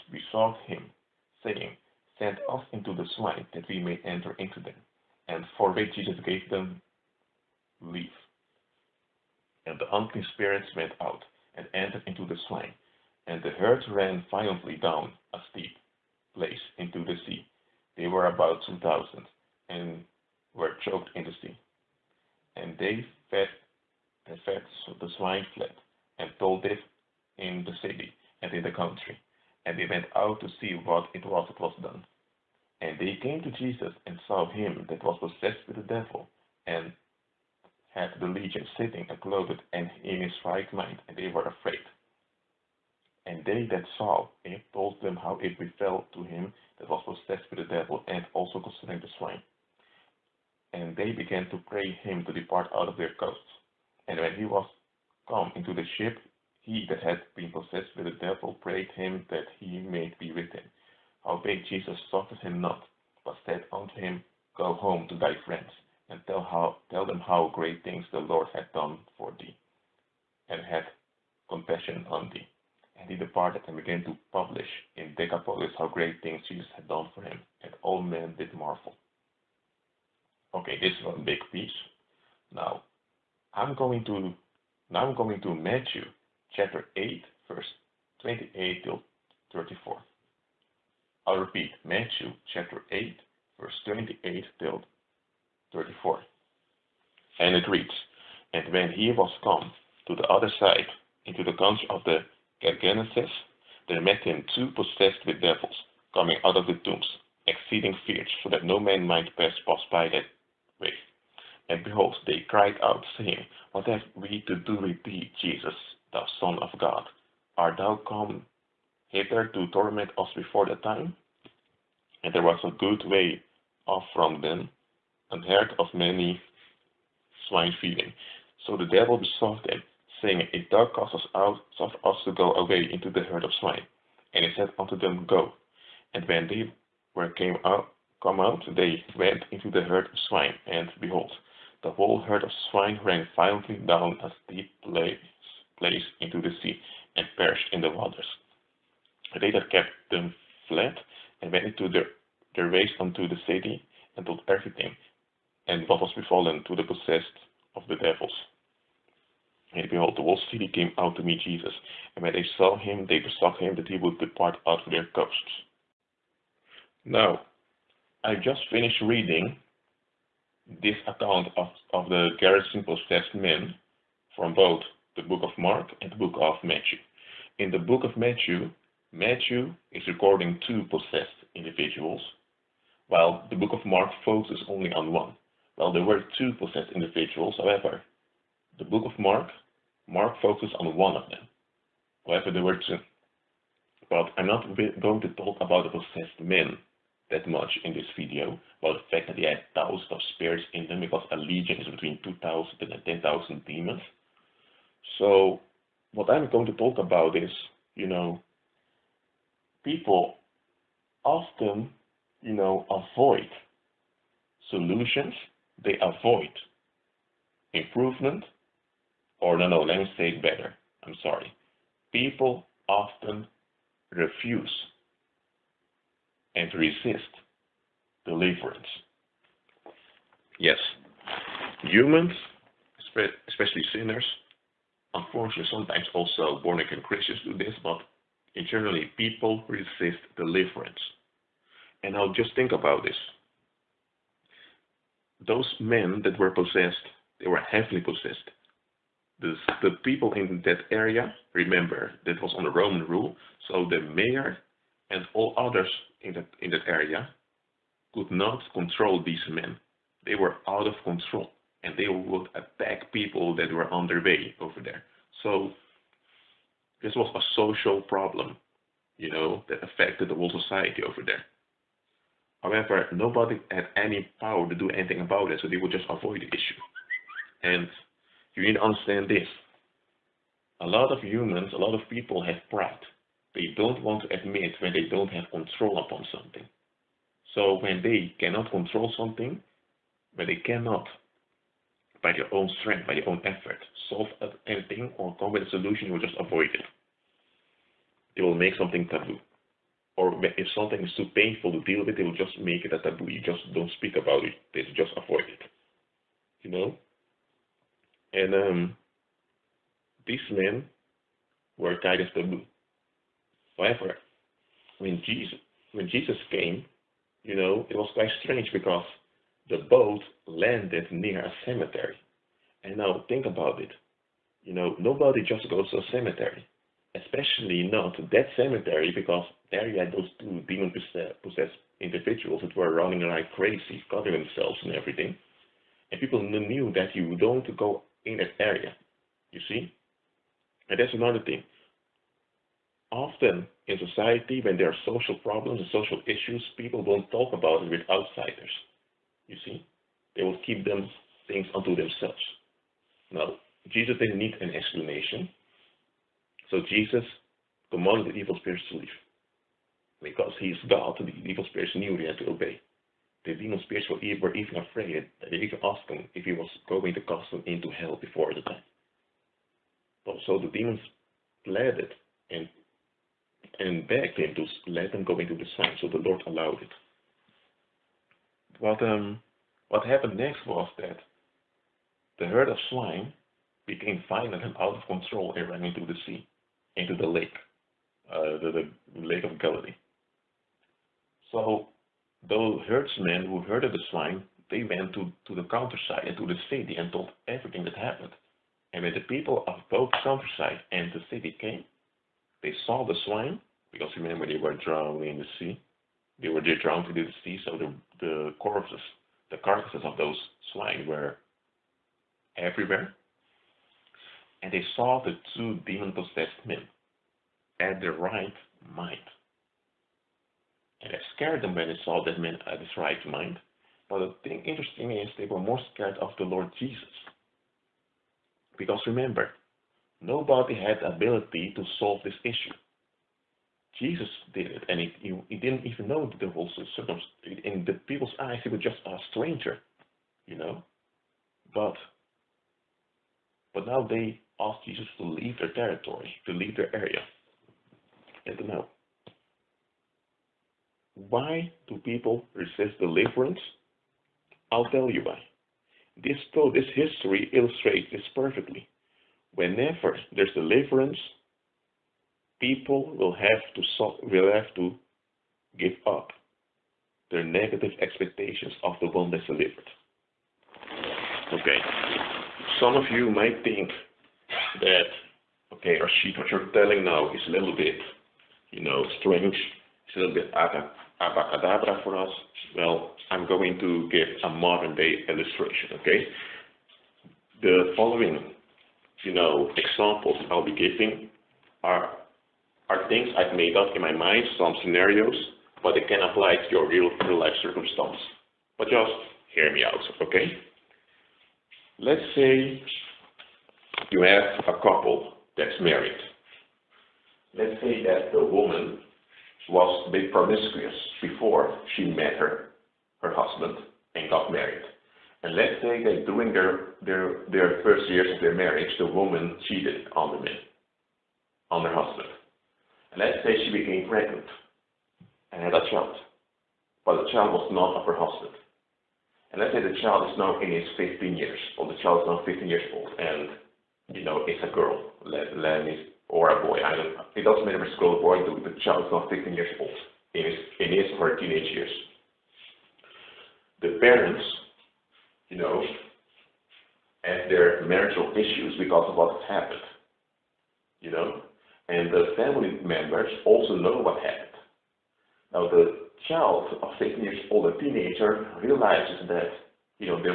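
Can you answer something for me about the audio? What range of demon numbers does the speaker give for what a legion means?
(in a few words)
2,000 to 10,000.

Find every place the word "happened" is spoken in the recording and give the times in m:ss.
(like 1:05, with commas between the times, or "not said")
6:20, 6:37, 9:09, 9:14.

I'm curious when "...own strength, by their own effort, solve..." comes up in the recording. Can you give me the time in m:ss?
4:52.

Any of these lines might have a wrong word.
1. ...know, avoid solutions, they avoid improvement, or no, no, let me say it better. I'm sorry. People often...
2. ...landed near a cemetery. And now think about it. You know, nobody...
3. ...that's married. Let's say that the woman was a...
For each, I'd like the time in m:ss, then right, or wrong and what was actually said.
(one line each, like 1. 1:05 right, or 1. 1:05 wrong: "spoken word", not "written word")
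1. 3:32 right
2. 5:20 right
3. 8:25 right.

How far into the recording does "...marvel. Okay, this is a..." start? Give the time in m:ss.
1:18.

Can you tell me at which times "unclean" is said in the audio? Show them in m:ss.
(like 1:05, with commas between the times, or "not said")
0:09.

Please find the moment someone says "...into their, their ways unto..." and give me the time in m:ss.
2:31.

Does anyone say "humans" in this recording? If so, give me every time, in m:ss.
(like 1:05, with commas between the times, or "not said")
3:51, 4:41.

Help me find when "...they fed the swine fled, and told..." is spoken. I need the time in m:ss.
0:24.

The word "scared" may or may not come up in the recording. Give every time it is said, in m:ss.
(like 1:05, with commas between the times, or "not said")
7:01, 7:05.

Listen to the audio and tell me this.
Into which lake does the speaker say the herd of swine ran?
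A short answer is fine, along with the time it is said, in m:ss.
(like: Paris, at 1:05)
Lake of Galilee, at 6:29.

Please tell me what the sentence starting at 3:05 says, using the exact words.
Well, there were two possessed individuals, however, the book of Mark Mark focused on one of them.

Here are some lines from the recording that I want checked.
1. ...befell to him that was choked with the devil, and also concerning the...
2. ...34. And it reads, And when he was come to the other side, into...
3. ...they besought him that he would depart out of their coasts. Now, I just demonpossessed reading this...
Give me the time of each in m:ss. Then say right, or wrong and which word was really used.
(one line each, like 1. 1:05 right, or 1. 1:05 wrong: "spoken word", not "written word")
1. 0:45 wrong: "possessed", not "choked"
2. 1:35 right
3. 2:43 wrong: "finished", not "demonpossessed".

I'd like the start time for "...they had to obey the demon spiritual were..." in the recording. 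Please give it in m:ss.
6:02.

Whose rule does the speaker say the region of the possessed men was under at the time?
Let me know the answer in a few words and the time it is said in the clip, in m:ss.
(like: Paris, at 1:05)
Roman, at 4:12.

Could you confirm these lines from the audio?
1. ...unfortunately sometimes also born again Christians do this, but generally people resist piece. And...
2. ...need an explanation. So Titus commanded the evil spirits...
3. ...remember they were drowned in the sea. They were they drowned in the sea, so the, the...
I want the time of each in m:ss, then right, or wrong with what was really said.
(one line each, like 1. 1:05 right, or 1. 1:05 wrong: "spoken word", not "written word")
1. 3:55 wrong: "deliverance", not "piece"
2. 5:54 wrong: "Jesus", not "Titus"
3. 6:44 right.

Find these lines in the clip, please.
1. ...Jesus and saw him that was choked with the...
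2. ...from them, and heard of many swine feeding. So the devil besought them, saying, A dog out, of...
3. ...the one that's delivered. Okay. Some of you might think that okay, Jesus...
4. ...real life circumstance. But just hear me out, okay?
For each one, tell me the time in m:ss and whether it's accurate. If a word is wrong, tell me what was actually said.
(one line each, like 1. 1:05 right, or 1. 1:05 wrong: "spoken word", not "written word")
1. 0:33 wrong: "possessed", not "choked"
2. 2:04 right
3. 7:49 wrong: "Rashid", not "Jesus"
4. 8:17 right.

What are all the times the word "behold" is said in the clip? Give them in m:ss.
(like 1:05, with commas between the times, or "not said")
1:51, 2:20, 2:39.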